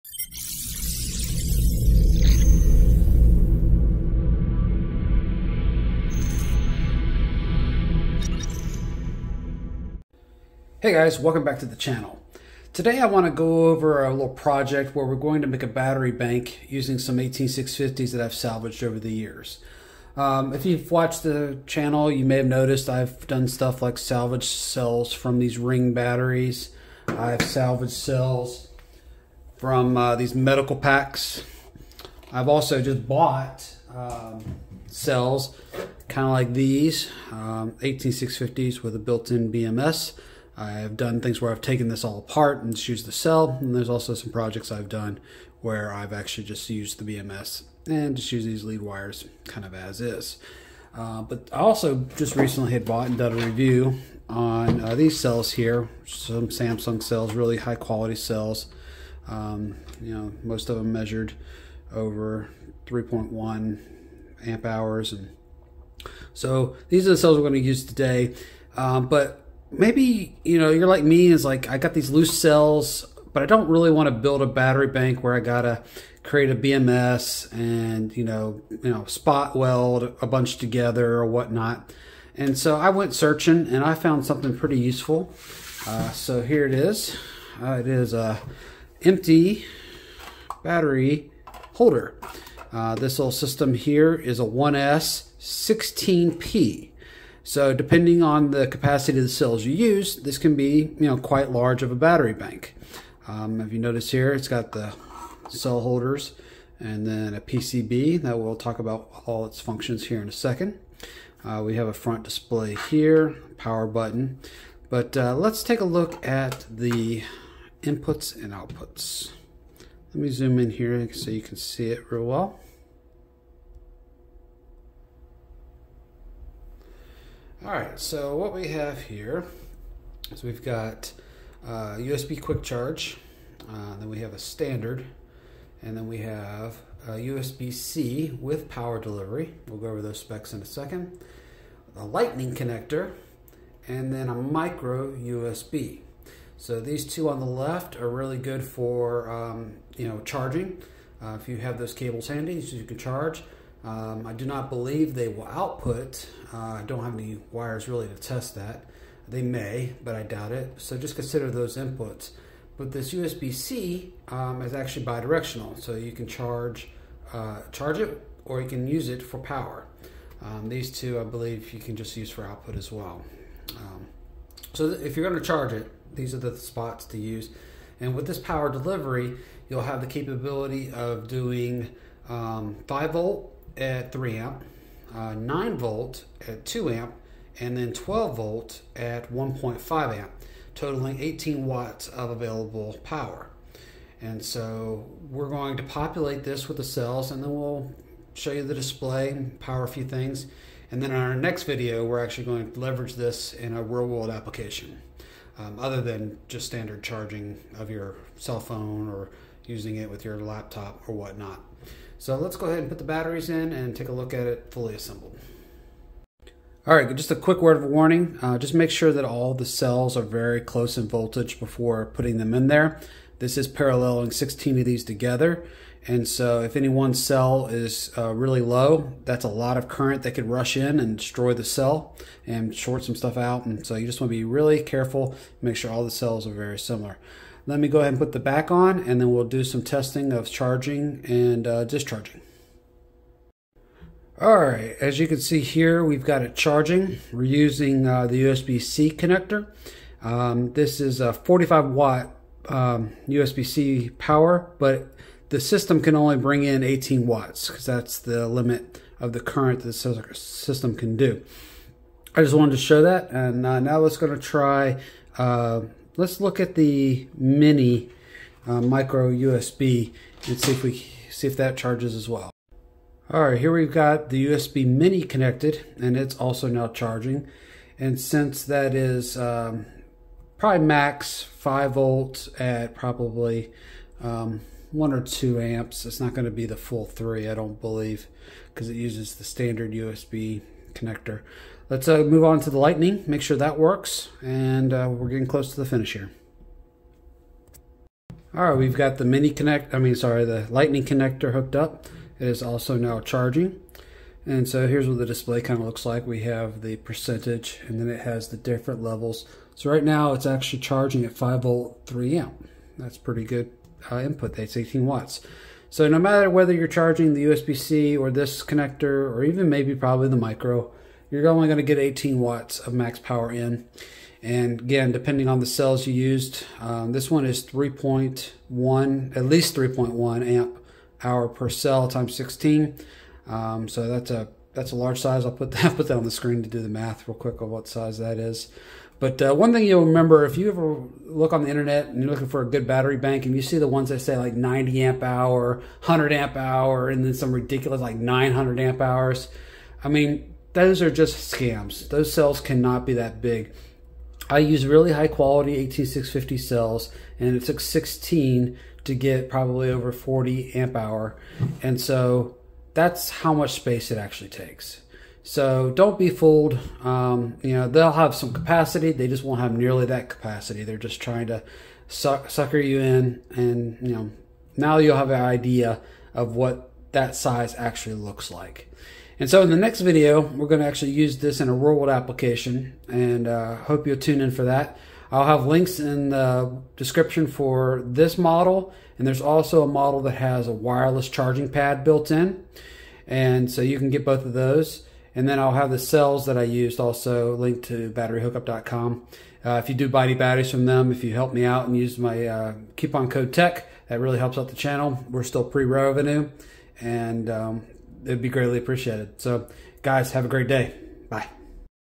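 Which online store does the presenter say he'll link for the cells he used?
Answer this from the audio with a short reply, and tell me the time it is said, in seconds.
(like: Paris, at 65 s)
batteryhookup.com, at 398 s.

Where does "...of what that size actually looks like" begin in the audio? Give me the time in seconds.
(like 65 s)
376 s.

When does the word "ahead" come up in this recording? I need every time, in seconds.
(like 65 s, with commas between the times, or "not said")
212 s, 237 s.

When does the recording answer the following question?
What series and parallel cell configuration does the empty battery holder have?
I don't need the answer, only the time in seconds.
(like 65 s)
94 s.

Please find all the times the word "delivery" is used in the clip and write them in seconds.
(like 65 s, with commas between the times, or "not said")
138 s, 178 s.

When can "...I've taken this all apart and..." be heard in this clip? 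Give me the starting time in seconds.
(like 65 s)
41 s.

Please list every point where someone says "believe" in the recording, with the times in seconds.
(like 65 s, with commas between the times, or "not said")
154 s, 171 s, 287 s.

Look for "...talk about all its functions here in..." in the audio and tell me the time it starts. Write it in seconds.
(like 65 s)
108 s.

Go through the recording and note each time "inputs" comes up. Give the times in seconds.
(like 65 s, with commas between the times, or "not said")
117 s, 161 s, 314 s.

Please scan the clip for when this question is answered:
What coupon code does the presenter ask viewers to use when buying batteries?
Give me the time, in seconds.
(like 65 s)
403 s.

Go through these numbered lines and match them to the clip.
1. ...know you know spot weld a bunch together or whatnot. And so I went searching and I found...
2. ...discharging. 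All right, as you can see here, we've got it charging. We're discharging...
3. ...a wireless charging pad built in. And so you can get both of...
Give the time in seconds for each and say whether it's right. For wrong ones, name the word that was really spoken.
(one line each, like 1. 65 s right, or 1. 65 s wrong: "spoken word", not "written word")
1. 78 s right
2. 241 s wrong: "using", not "discharging"
3. 390 s right.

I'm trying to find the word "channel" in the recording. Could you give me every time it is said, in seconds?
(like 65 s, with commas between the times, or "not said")
11 s, 21 s, 404 s.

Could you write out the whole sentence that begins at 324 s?
And again, depending on the cells you used, um, this one is 3.1, at least 3.1 amp hour per cell times 16.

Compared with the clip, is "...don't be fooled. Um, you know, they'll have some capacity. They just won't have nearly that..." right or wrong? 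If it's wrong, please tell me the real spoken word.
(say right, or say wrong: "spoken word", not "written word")
right.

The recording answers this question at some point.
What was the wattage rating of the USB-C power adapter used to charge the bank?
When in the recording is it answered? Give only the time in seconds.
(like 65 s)
251 s.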